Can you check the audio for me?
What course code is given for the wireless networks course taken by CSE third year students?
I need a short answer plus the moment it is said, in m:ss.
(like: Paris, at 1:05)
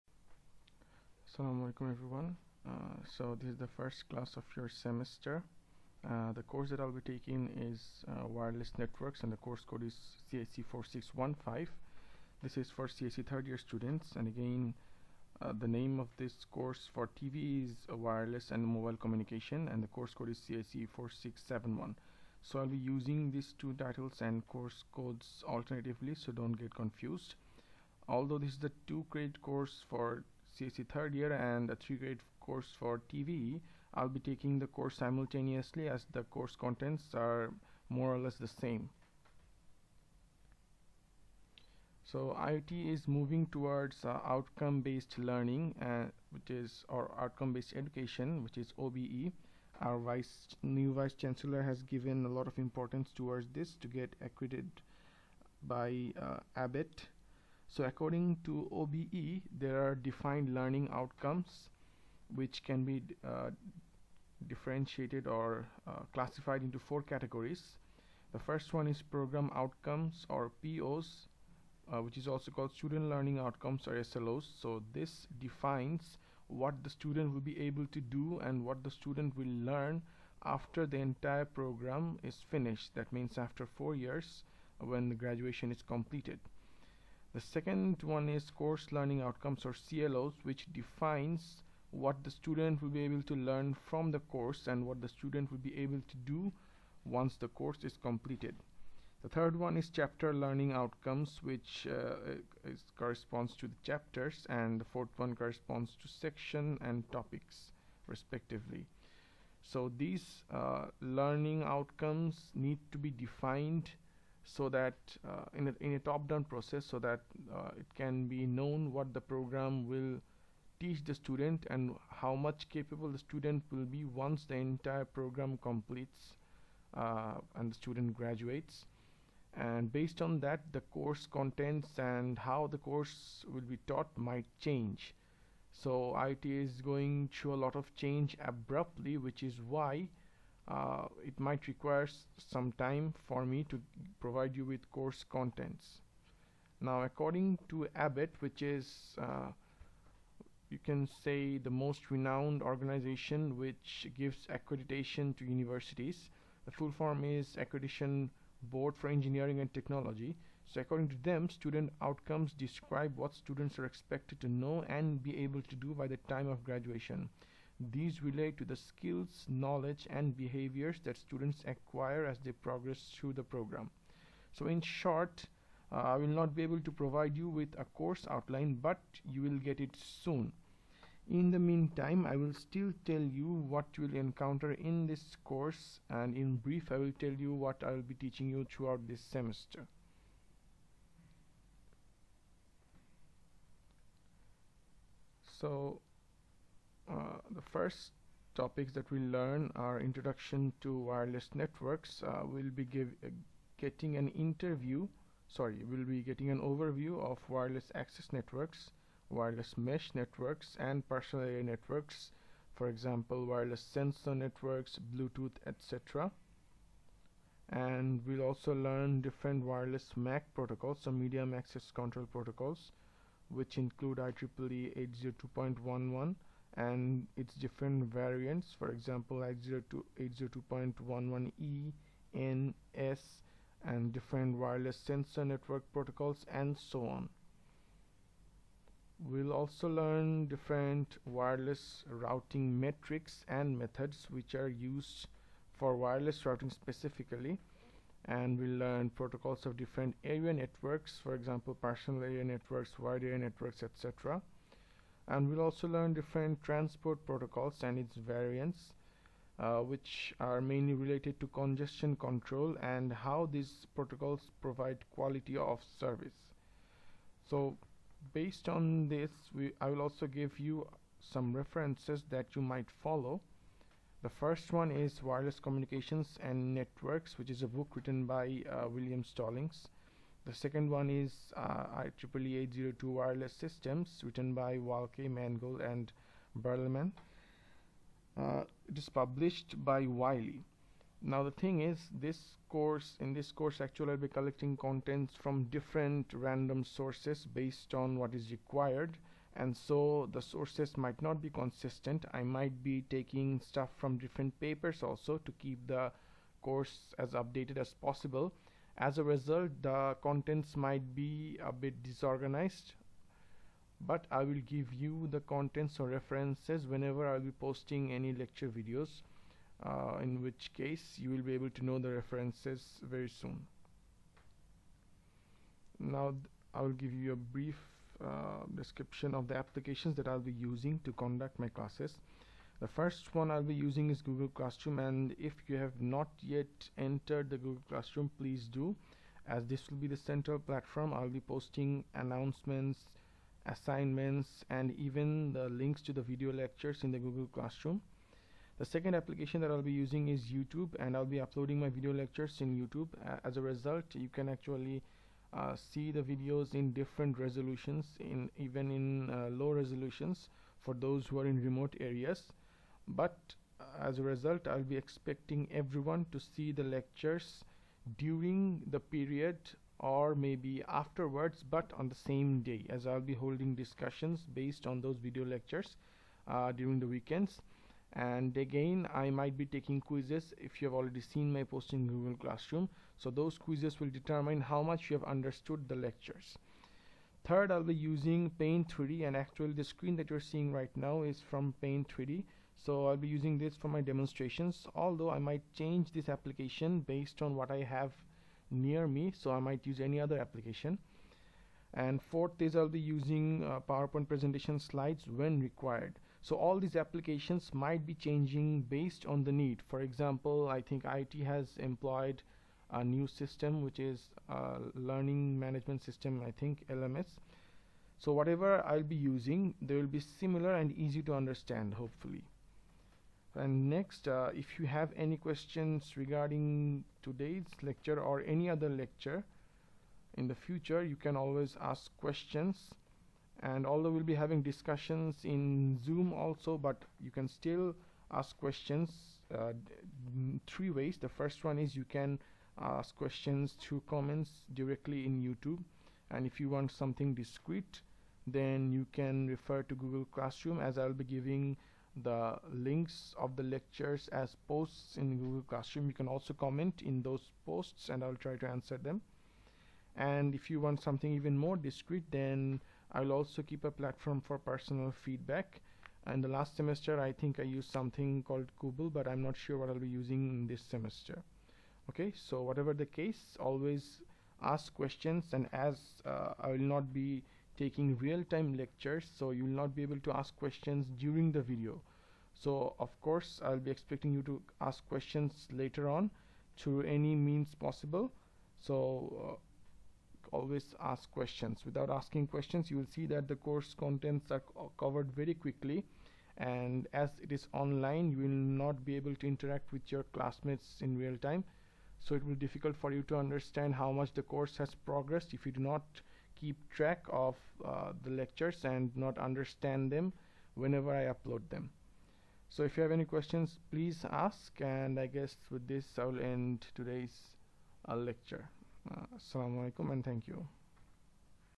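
CSE 4615, at 0:10.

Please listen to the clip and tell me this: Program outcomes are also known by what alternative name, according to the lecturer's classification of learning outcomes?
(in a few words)
student learning outcomes.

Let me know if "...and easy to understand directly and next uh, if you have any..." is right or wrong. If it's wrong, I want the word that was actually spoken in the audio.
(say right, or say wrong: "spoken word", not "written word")
wrong: "hopefully", not "directly".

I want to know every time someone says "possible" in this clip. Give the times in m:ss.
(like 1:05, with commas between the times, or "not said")
5:08, 8:07.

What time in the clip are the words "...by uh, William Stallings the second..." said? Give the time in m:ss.
4:38.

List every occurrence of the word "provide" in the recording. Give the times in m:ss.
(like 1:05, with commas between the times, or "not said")
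2:24, 2:56, 4:24.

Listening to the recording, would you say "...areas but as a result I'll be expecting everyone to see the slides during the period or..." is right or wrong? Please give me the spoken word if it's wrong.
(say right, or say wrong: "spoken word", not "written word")
wrong: "lectures", not "slides".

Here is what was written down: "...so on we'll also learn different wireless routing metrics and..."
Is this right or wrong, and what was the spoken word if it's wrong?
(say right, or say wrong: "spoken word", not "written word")
right.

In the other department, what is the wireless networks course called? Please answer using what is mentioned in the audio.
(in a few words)
wireless and mobile communication.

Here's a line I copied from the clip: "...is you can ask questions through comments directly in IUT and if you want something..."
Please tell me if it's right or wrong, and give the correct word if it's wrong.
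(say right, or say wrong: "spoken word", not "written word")
wrong: "YouTube", not "IUT".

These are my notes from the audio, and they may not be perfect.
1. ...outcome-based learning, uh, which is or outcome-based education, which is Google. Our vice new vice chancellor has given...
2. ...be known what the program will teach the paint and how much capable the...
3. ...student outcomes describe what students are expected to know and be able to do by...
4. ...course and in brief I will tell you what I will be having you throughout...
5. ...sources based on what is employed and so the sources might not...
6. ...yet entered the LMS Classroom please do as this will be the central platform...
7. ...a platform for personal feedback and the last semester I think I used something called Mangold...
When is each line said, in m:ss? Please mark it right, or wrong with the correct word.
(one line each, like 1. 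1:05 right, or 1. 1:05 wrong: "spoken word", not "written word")
1. 0:44 wrong: "OBE", not "Google"
2. 1:58 wrong: "student", not "paint"
3. 2:41 right
4. 3:05 wrong: "teaching", not "having"
5. 4:56 wrong: "required", not "employed"
6. 5:36 wrong: "Google", not "LMS"
7. 7:43 wrong: "Google", not "Mangold".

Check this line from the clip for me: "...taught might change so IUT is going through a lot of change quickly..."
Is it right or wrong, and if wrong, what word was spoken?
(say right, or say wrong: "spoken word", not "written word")
wrong: "abruptly", not "quickly".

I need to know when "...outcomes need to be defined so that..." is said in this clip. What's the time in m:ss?
1:51.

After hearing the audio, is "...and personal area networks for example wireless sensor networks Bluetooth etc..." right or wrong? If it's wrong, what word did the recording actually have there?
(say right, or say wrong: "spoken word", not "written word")
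right.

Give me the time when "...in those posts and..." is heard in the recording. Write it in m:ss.
7:37.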